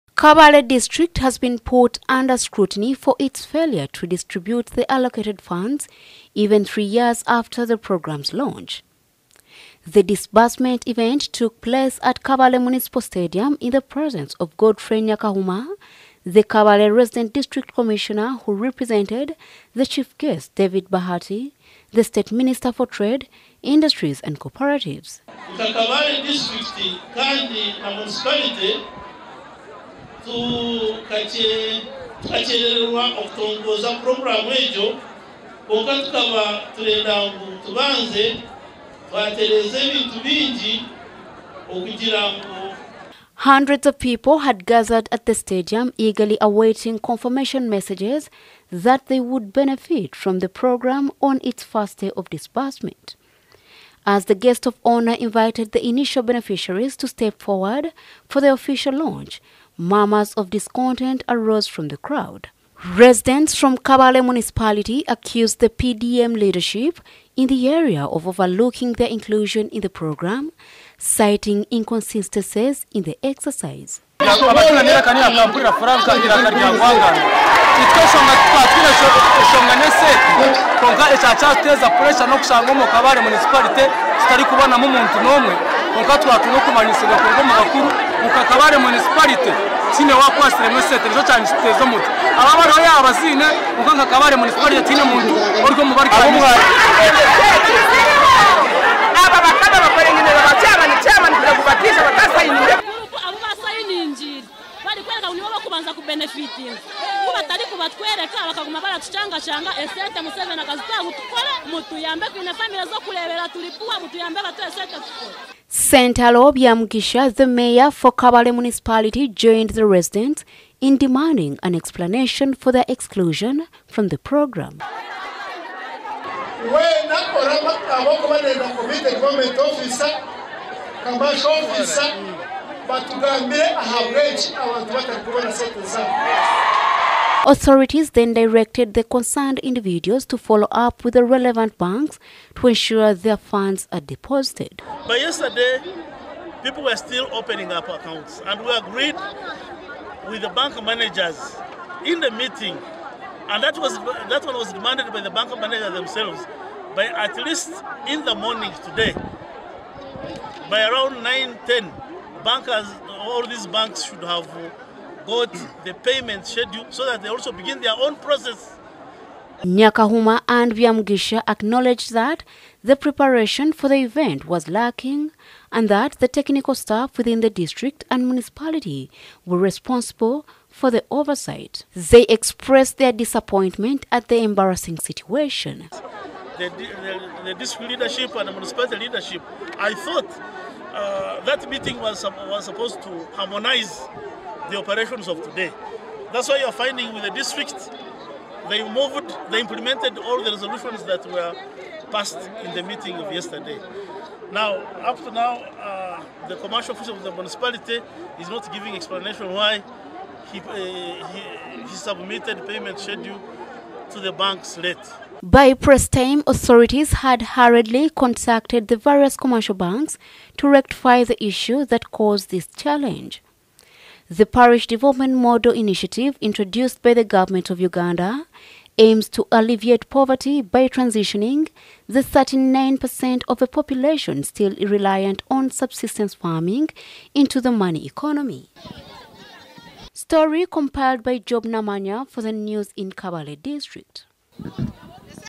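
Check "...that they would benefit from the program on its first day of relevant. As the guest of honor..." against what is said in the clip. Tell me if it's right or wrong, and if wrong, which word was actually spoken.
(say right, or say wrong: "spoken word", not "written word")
wrong: "disbursement", not "relevant".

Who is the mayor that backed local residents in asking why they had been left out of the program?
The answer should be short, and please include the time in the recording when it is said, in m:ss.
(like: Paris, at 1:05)
Sentaro Byamugisha, at 1:55.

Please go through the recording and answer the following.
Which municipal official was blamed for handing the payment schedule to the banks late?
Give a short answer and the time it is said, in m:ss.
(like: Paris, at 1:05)
commercial officer, at 3:26.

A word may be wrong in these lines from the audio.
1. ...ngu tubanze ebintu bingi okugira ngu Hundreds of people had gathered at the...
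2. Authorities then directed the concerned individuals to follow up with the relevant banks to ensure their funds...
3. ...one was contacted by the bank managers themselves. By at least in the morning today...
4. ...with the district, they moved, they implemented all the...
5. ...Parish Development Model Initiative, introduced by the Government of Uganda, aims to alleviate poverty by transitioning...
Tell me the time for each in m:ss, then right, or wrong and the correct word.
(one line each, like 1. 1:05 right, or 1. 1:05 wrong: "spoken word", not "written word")
1. 0:37 right
2. 2:17 right
3. 2:34 wrong: "demanded", not "contacted"
4. 3:17 right
5. 3:44 right.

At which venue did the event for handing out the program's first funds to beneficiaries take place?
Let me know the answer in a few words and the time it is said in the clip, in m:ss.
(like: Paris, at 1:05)
Kabale Municipal Stadium, at 0:12.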